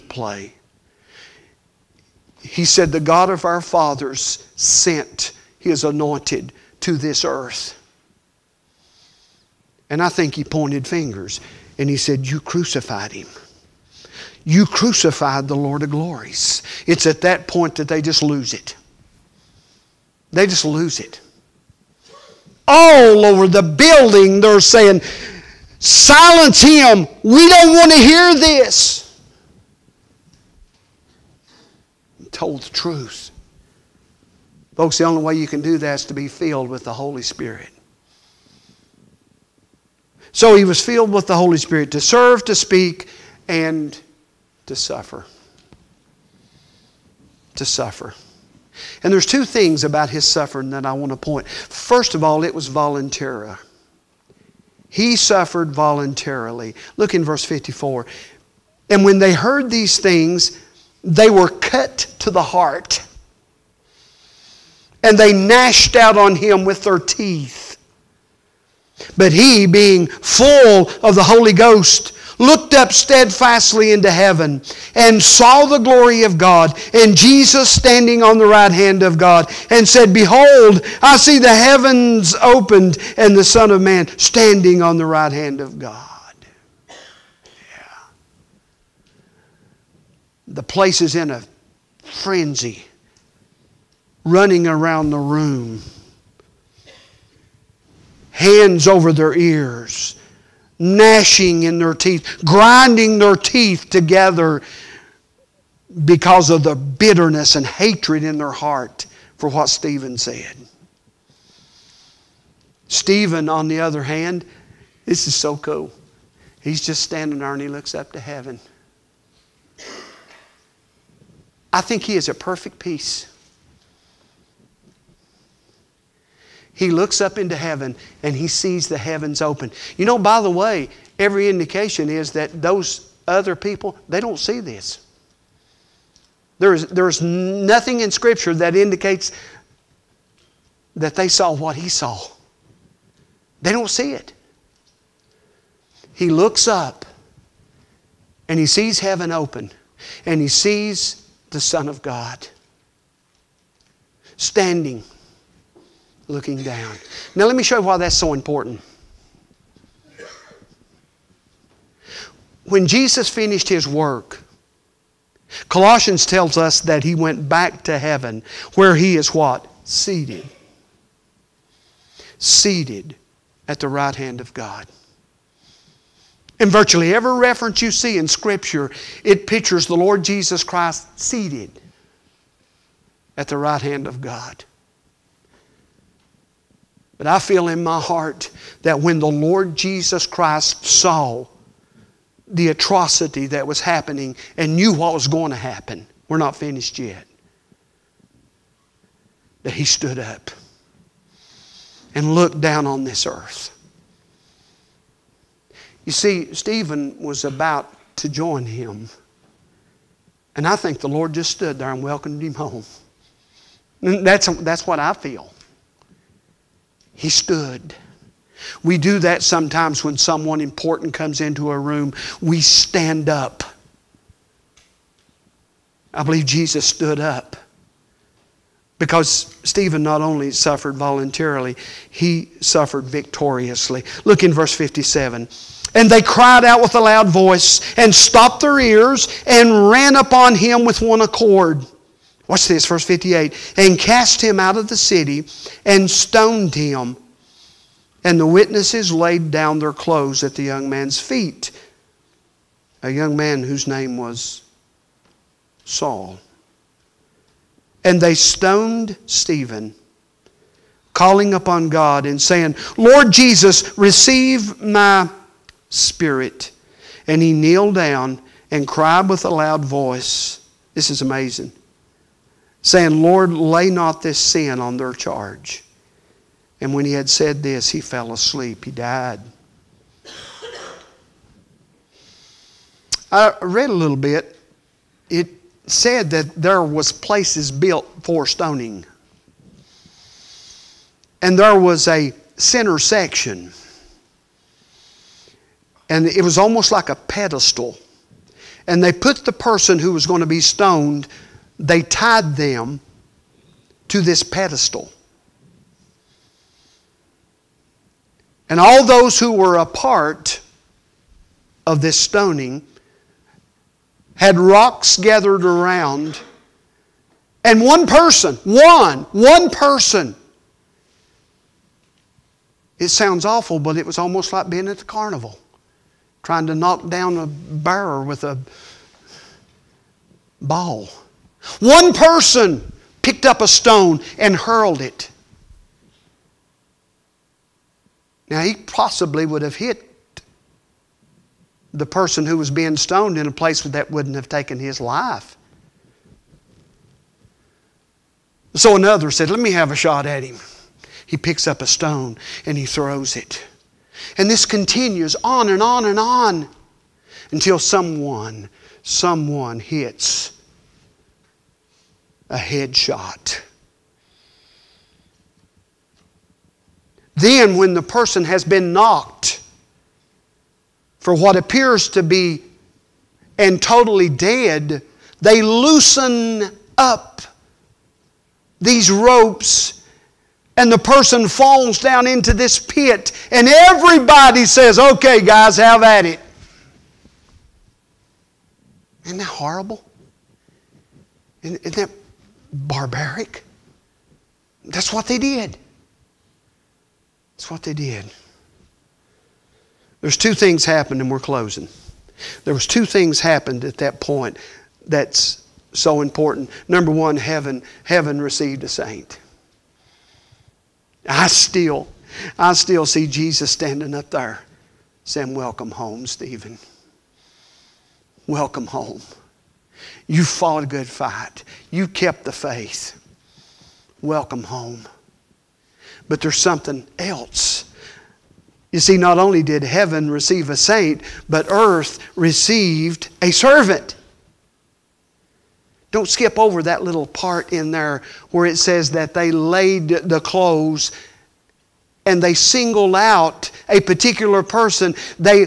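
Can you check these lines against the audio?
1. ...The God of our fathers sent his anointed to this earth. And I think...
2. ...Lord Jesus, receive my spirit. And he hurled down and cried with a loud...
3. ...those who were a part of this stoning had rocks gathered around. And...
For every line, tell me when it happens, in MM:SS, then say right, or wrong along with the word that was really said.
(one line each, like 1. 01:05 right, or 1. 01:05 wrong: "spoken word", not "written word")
1. 00:02 right
2. 04:22 wrong: "kneeled", not "hurled"
3. 05:09 right.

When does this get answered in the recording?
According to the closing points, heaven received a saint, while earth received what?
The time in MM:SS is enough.
07:13.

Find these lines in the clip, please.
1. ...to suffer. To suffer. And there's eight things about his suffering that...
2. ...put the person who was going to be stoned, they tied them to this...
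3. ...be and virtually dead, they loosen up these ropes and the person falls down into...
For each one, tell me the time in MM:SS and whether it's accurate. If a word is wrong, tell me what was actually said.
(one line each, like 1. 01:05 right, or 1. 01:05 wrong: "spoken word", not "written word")
1. 00:44 wrong: "two", not "eight"
2. 04:59 right
3. 06:12 wrong: "totally", not "virtually".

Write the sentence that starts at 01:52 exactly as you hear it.
Stephen, on the other hand, this is so cool.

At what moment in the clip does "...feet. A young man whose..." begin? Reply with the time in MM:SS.
04:11.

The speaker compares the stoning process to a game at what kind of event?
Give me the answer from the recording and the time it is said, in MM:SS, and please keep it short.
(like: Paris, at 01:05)
Carnival, at 05:24.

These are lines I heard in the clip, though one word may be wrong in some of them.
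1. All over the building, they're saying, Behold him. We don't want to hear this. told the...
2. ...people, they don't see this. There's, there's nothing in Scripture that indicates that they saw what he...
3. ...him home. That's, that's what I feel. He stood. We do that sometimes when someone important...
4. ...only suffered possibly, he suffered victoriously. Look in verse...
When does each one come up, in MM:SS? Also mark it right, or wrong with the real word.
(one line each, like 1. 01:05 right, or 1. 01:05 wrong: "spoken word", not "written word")
1. 00:22 wrong: "Silence", not "Behold"
2. 02:13 right
3. 03:32 right
4. 03:50 wrong: "voluntarily", not "possibly".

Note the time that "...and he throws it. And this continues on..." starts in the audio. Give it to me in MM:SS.
05:52.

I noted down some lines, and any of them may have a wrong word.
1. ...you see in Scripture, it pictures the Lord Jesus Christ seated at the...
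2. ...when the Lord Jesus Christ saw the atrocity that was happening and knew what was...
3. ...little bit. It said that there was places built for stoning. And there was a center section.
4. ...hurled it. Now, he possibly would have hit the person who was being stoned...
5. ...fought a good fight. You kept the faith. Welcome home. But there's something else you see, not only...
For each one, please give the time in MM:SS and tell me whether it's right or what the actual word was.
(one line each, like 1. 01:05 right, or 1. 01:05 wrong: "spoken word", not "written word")
1. 02:57 right
2. 03:08 right
3. 04:43 right
4. 05:34 right
5. 07:00 right.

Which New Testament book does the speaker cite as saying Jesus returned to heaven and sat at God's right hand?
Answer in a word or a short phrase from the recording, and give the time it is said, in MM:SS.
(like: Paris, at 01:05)
Colossians, at 02:45.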